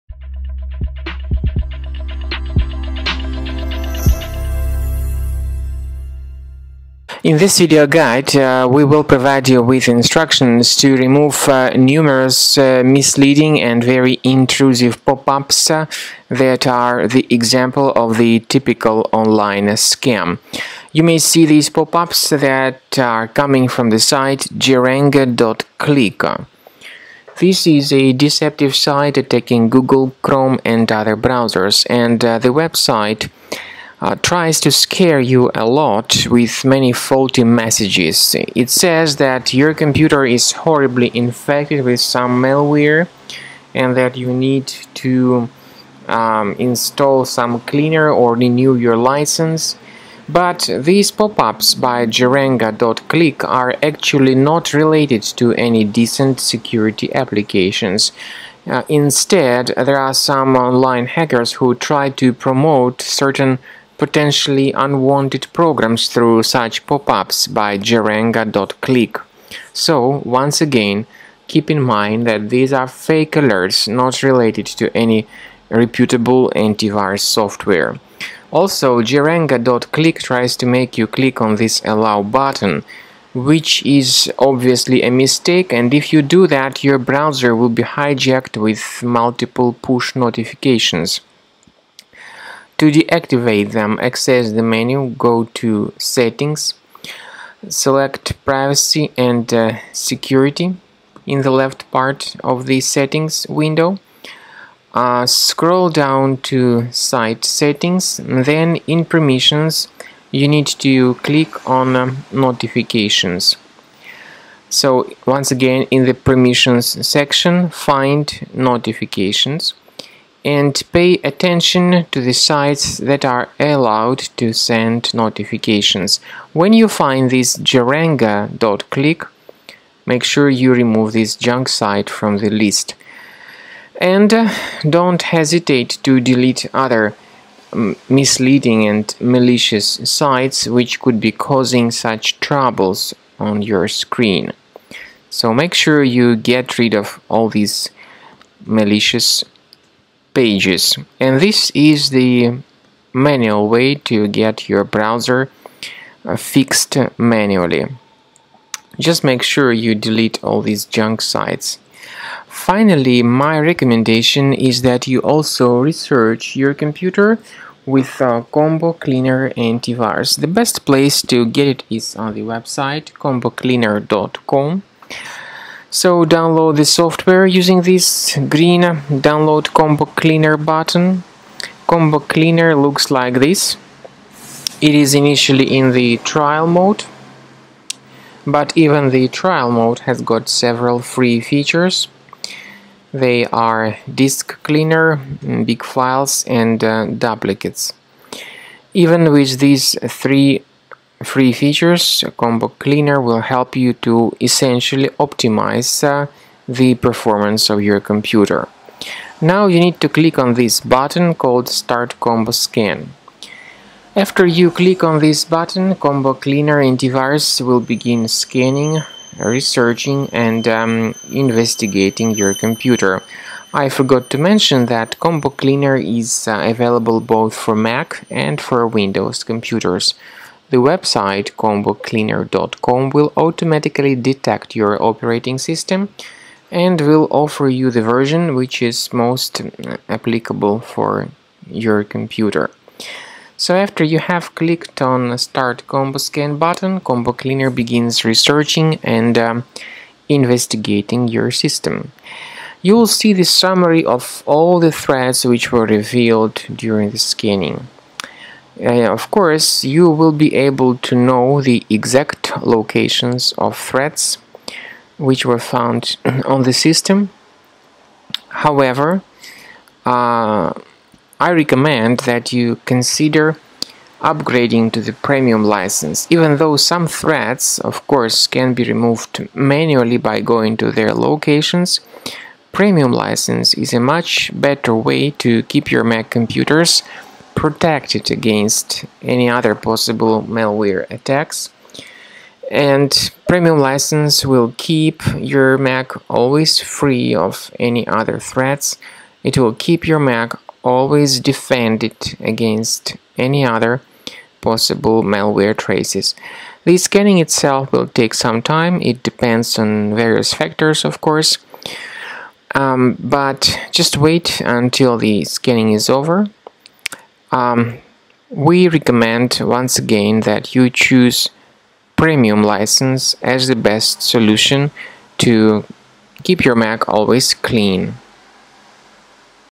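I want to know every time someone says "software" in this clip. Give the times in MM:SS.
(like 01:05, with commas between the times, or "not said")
01:17, 02:56.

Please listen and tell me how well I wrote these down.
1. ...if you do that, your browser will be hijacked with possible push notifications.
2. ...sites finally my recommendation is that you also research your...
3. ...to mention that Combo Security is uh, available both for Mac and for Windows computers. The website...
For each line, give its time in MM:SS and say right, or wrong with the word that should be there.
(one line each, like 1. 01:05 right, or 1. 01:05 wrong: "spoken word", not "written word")
1. 01:25 wrong: "multiple", not "possible"
2. 02:41 right
3. 03:44 wrong: "Cleaner", not "Security".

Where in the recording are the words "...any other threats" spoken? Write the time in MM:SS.
04:57.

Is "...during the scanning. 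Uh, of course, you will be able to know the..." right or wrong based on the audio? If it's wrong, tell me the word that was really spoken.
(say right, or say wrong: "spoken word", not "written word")
right.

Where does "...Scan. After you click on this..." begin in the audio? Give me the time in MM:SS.
03:32.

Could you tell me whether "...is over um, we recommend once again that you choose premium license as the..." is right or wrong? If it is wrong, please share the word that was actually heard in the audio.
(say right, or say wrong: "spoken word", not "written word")
right.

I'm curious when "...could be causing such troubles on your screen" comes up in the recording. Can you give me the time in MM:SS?
02:20.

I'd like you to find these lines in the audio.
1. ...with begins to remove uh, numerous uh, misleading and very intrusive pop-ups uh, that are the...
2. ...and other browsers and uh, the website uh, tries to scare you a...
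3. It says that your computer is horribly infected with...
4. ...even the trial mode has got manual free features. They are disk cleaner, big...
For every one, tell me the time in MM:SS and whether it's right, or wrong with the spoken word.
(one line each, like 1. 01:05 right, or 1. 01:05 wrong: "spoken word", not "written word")
1. 00:09 wrong: "instructions", not "begins"
2. 00:30 right
3. 00:38 right
4. 03:08 wrong: "several", not "manual".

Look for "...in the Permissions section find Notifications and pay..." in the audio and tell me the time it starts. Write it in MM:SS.
01:55.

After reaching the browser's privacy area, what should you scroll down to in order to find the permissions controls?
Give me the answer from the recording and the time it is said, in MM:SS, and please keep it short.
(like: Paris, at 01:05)
Site Settings, at 01:46.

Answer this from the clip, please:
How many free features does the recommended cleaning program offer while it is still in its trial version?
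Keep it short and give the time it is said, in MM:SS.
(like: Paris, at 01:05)
3, at 03:20.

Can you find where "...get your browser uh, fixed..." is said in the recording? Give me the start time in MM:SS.
02:34.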